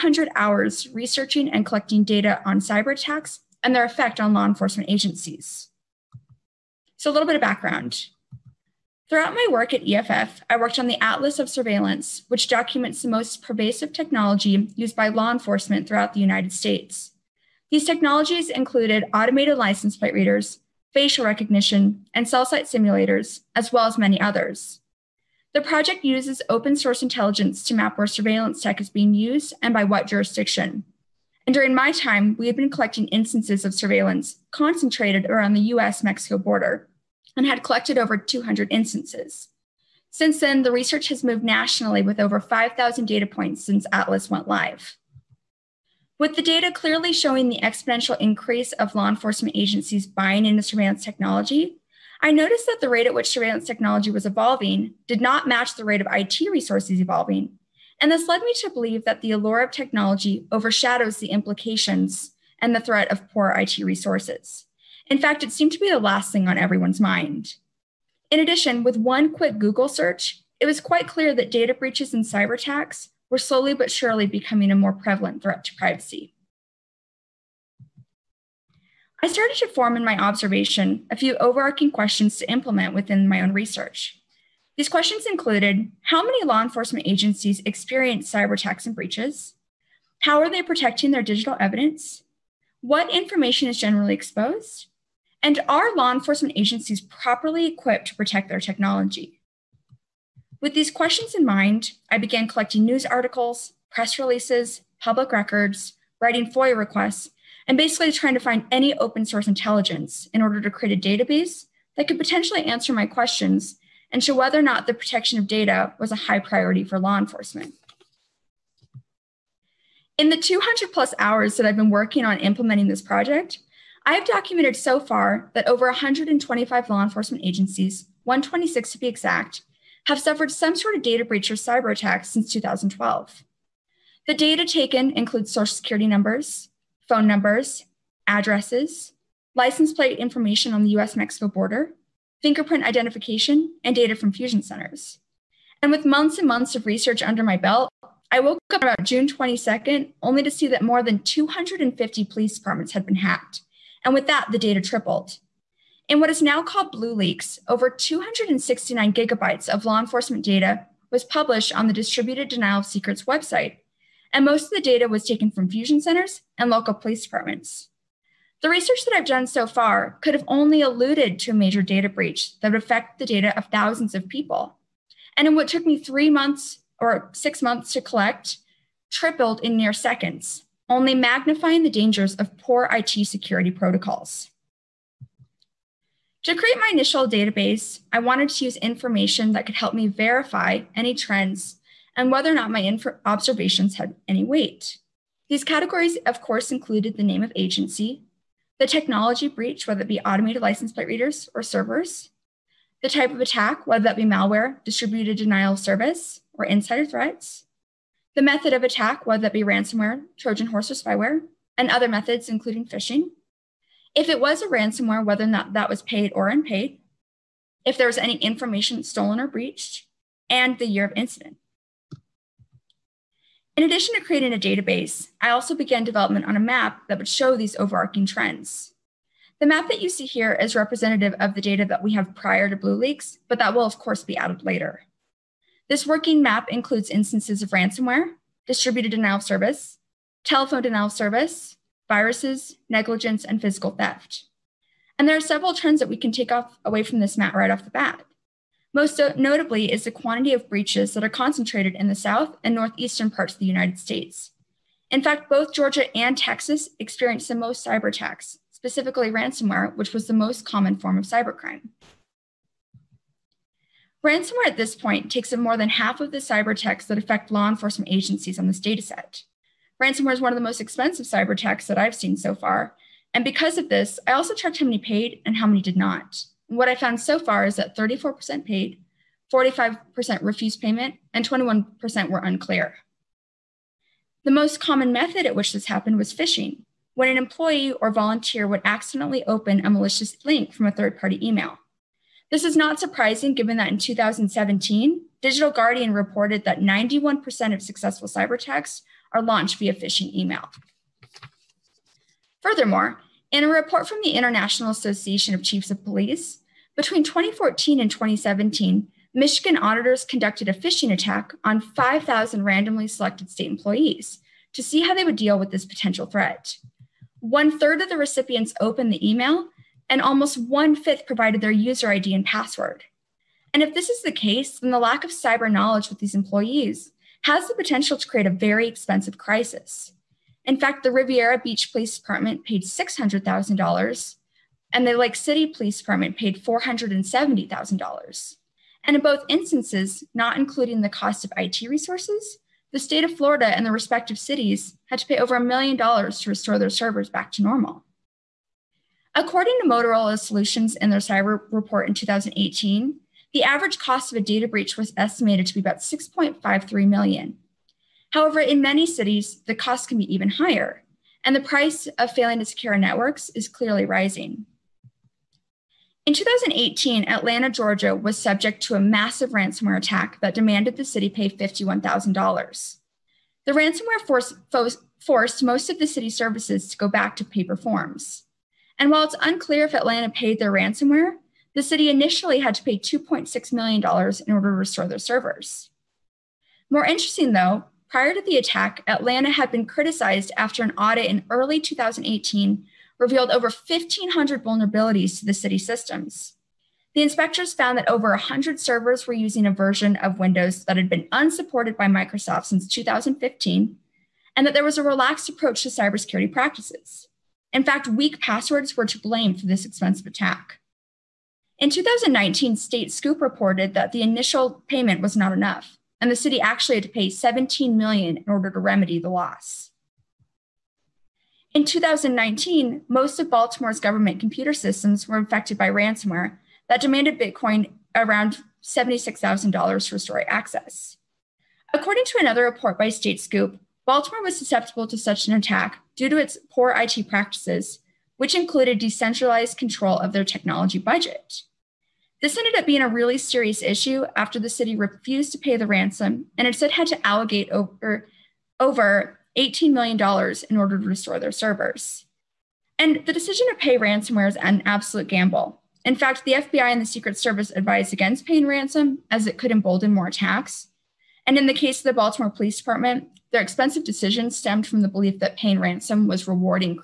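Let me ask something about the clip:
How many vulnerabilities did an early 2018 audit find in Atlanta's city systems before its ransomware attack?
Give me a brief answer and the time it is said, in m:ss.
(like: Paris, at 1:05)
over 1,500, at 6:33.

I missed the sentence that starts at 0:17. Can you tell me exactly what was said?
These technologies included automated license plate readers, facial recognition, and cell site simulators, as well as many others.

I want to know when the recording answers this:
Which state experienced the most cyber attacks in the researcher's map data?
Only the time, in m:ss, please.
4:15.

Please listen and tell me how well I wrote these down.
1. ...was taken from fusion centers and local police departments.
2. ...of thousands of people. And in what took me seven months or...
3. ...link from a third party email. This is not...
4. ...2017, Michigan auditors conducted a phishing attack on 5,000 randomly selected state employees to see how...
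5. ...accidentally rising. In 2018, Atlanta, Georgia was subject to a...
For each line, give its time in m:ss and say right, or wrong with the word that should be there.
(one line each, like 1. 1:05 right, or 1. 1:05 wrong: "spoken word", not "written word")
1. 2:45 right
2. 2:53 wrong: "three", not "seven"
3. 4:50 right
4. 5:08 right
5. 6:03 wrong: "clearly", not "accidentally".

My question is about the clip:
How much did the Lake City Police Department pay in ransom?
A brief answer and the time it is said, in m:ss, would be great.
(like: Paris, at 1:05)
$470,000, at 5:36.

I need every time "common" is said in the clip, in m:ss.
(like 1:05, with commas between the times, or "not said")
4:20, 4:44.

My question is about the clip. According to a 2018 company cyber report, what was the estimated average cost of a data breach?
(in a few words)
6.53 million.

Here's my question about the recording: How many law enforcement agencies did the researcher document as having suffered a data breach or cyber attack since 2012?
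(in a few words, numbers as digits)
126.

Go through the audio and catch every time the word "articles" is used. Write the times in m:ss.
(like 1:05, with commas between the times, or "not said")
1:43.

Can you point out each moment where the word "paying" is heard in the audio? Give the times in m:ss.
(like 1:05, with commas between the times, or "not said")
7:38, 7:45.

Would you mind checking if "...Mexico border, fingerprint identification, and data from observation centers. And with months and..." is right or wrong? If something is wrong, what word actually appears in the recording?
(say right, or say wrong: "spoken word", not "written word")
wrong: "fusion", not "observation".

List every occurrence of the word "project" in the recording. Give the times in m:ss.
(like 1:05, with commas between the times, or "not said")
0:25, 2:03.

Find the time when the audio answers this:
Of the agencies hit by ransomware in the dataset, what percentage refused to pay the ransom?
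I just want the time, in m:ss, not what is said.
4:39.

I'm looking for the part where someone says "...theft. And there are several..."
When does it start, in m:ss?
4:03.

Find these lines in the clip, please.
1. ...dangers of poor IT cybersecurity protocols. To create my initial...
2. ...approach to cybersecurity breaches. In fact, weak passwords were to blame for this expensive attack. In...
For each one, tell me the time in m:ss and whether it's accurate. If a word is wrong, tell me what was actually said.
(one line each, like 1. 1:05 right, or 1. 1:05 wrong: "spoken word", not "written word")
1. 3:01 wrong: "security", not "cybersecurity"
2. 6:45 wrong: "practices", not "breaches".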